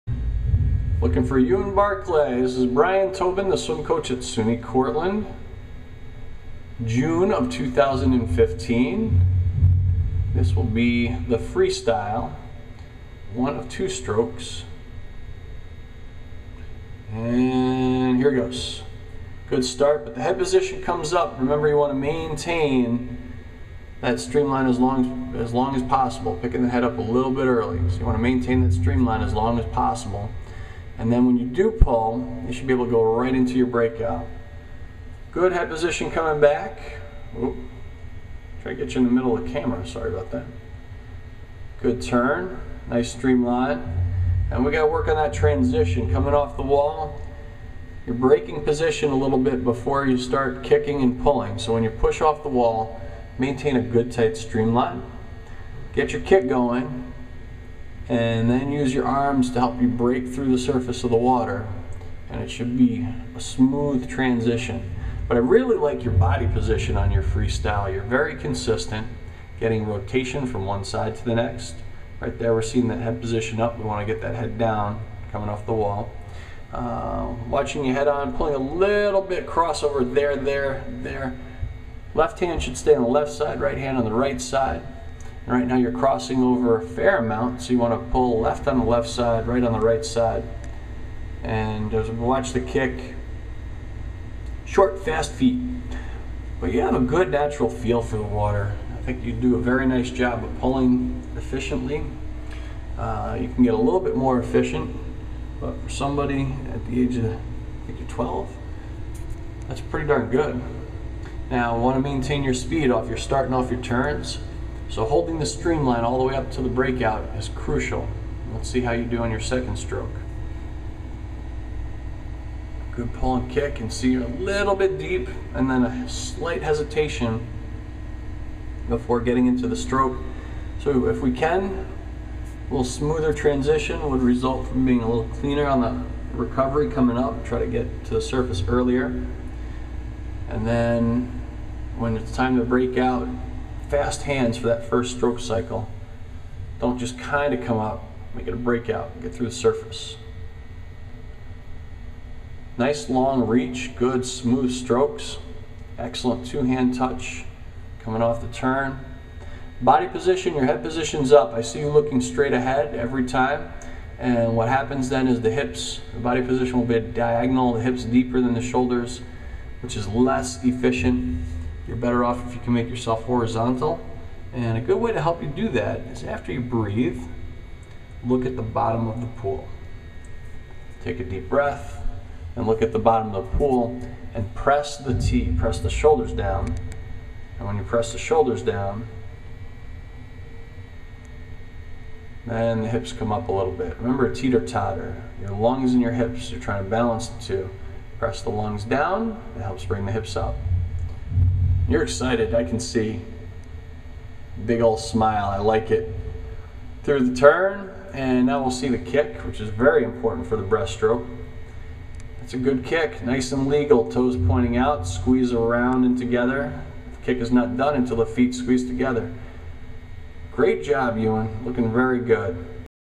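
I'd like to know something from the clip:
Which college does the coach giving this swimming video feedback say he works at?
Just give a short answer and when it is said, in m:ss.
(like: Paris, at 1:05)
SUNY Cortland, at 0:04.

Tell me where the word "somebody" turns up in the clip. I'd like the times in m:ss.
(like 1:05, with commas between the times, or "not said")
1:45.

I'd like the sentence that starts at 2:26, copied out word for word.
Don't just kind of come up, make it a breakout, get through the surface.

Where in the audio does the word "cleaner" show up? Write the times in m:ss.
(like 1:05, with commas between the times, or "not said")
2:15.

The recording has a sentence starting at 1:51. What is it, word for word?
Now, want to maintain your speed off.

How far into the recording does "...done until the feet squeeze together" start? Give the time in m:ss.
3:37.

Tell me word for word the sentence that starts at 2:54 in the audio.
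And a good way to help you do that is after you breathe, look at the bottom of the pool.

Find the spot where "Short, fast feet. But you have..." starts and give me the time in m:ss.
1:34.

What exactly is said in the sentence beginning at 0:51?
So when you push off the wall, maintain a good tight streamline.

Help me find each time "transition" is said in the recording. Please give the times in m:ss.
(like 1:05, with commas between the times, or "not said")
0:45, 1:04, 2:13.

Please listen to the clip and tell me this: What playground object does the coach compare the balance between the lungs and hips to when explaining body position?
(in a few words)
Teeter-totter.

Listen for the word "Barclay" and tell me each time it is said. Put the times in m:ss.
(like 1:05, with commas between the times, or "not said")
0:01.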